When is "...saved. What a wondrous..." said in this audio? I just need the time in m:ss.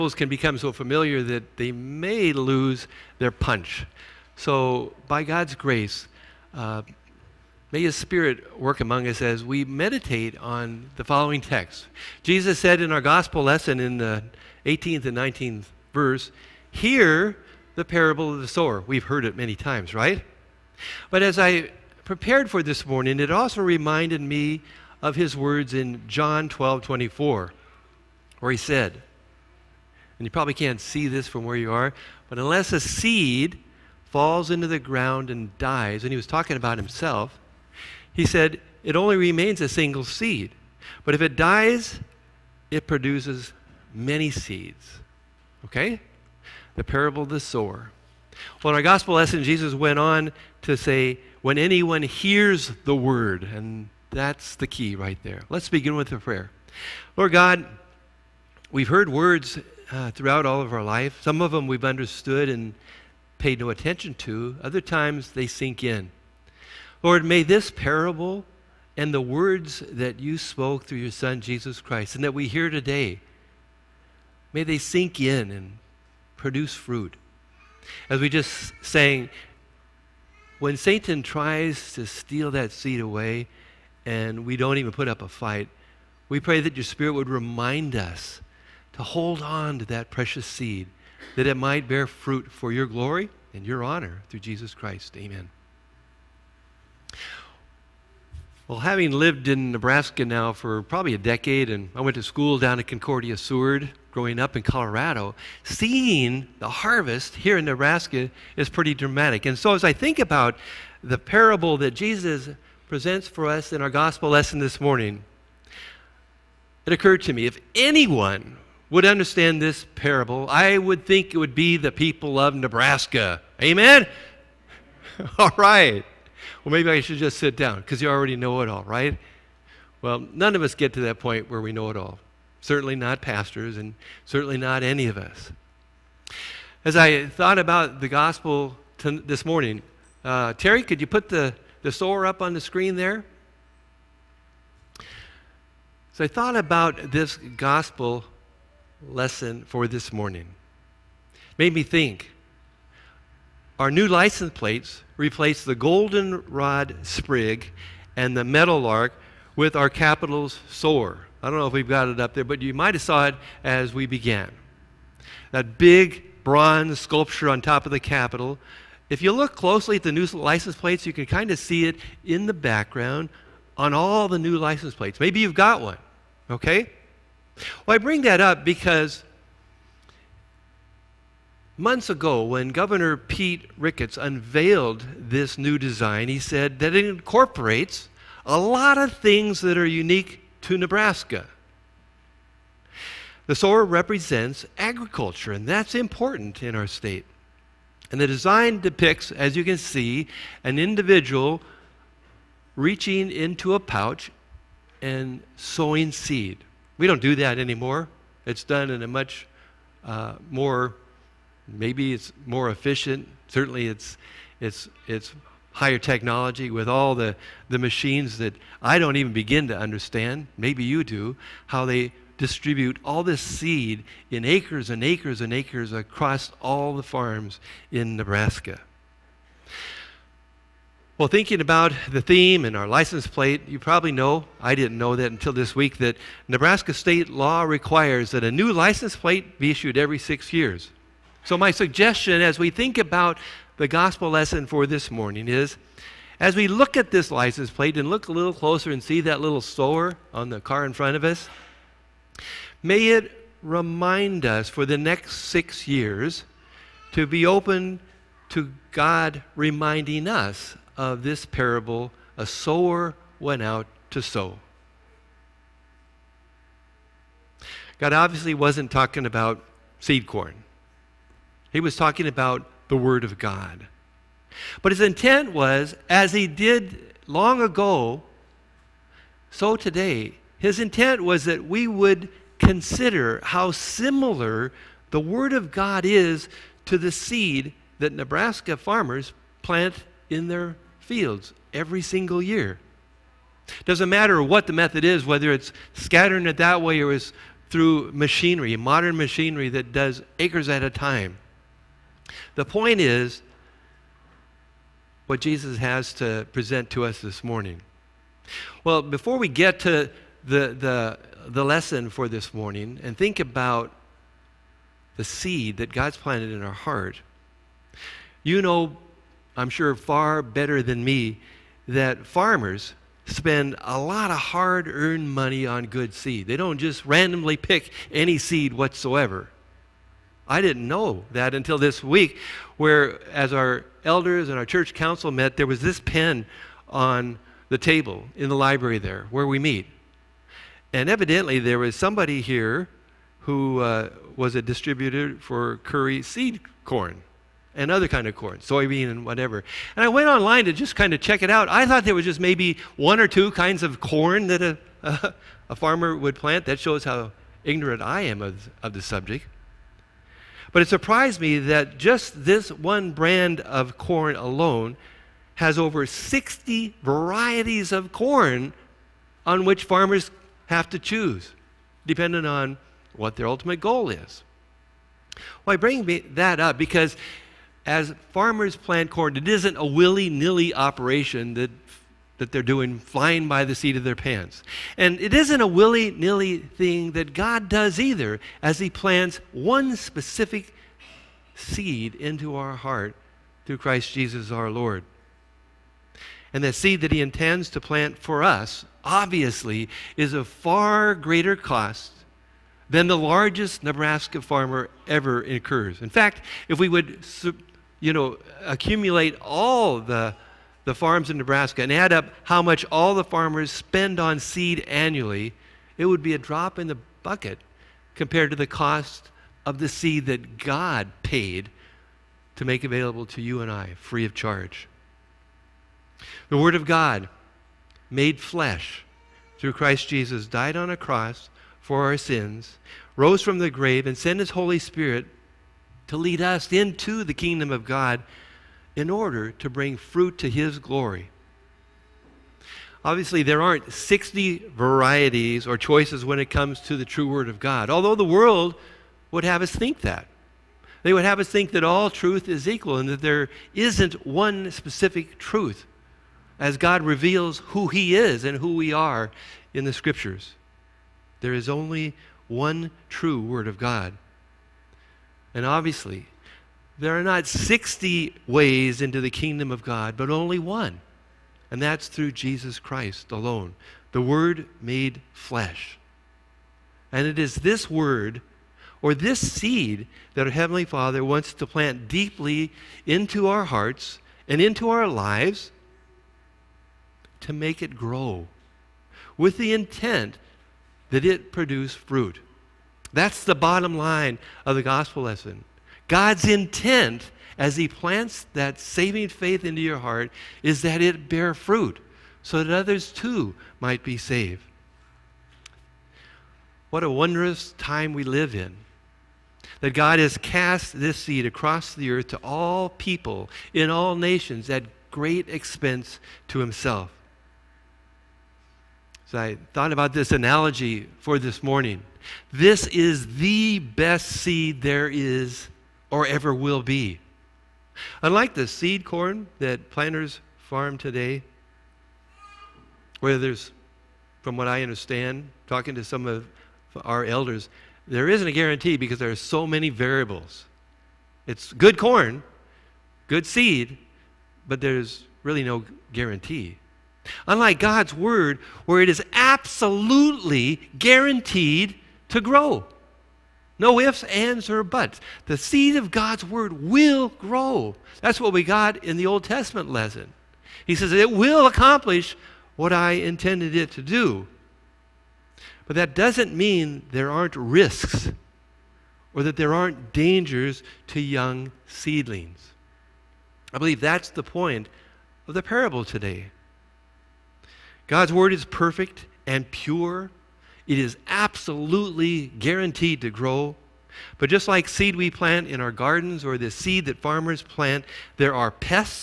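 8:24.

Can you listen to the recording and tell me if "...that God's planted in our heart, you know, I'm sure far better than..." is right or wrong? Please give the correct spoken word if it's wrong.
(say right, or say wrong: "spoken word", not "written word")
right.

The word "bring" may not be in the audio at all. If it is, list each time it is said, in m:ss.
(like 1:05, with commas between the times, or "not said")
2:57, 6:15, 7:19.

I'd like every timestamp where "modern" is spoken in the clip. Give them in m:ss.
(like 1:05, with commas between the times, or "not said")
4:58.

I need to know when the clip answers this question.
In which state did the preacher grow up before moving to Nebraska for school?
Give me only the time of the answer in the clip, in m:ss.
1:44.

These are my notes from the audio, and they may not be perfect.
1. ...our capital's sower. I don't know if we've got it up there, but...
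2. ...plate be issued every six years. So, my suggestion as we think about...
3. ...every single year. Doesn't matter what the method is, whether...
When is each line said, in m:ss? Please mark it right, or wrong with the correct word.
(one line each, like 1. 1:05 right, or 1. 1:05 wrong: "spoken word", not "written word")
1. 2:39 right
2. 3:59 right
3. 4:51 right.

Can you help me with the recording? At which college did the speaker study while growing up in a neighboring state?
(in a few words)
Concordia Seward.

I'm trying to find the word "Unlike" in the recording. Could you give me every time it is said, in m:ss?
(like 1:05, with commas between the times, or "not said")
8:48, 9:07.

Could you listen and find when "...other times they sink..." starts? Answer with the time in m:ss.
1:04.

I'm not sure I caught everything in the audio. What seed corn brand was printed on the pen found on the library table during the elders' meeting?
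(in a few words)
Curry.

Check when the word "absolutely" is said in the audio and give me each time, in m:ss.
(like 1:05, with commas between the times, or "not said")
9:09, 9:41.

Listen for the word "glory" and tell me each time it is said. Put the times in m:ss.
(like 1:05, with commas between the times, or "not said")
1:32, 7:20.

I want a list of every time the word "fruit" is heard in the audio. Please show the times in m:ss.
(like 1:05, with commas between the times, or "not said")
1:16, 1:32, 7:19, 8:11, 8:21.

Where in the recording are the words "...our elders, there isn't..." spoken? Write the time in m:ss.
8:57.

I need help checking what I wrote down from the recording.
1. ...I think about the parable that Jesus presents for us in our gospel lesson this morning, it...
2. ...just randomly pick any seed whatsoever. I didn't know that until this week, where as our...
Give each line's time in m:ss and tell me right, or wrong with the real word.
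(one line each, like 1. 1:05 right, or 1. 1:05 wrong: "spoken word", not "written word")
1. 1:49 right
2. 5:26 right.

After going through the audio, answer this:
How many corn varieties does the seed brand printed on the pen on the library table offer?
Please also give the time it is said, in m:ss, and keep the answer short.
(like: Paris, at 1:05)
Over 60, at 6:05.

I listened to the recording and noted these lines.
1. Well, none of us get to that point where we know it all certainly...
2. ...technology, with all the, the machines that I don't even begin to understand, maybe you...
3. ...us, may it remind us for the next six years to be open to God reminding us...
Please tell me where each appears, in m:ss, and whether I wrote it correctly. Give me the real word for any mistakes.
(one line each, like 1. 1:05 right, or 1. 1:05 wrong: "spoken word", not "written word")
1. 2:10 right
2. 3:35 right
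3. 4:11 right.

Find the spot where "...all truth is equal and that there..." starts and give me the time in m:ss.
7:31.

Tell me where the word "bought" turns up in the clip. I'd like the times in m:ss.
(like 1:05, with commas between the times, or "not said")
not said.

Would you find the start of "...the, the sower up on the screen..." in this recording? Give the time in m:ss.
2:21.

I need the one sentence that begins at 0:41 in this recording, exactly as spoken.
But if it dies, it produces many seeds.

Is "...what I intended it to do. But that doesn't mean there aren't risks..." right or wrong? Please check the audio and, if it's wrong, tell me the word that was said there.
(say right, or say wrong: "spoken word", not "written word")
right.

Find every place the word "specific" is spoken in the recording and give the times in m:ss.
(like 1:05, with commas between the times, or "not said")
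6:29, 7:34.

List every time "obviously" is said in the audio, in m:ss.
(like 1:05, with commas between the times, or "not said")
4:28, 6:39, 7:23, 7:45.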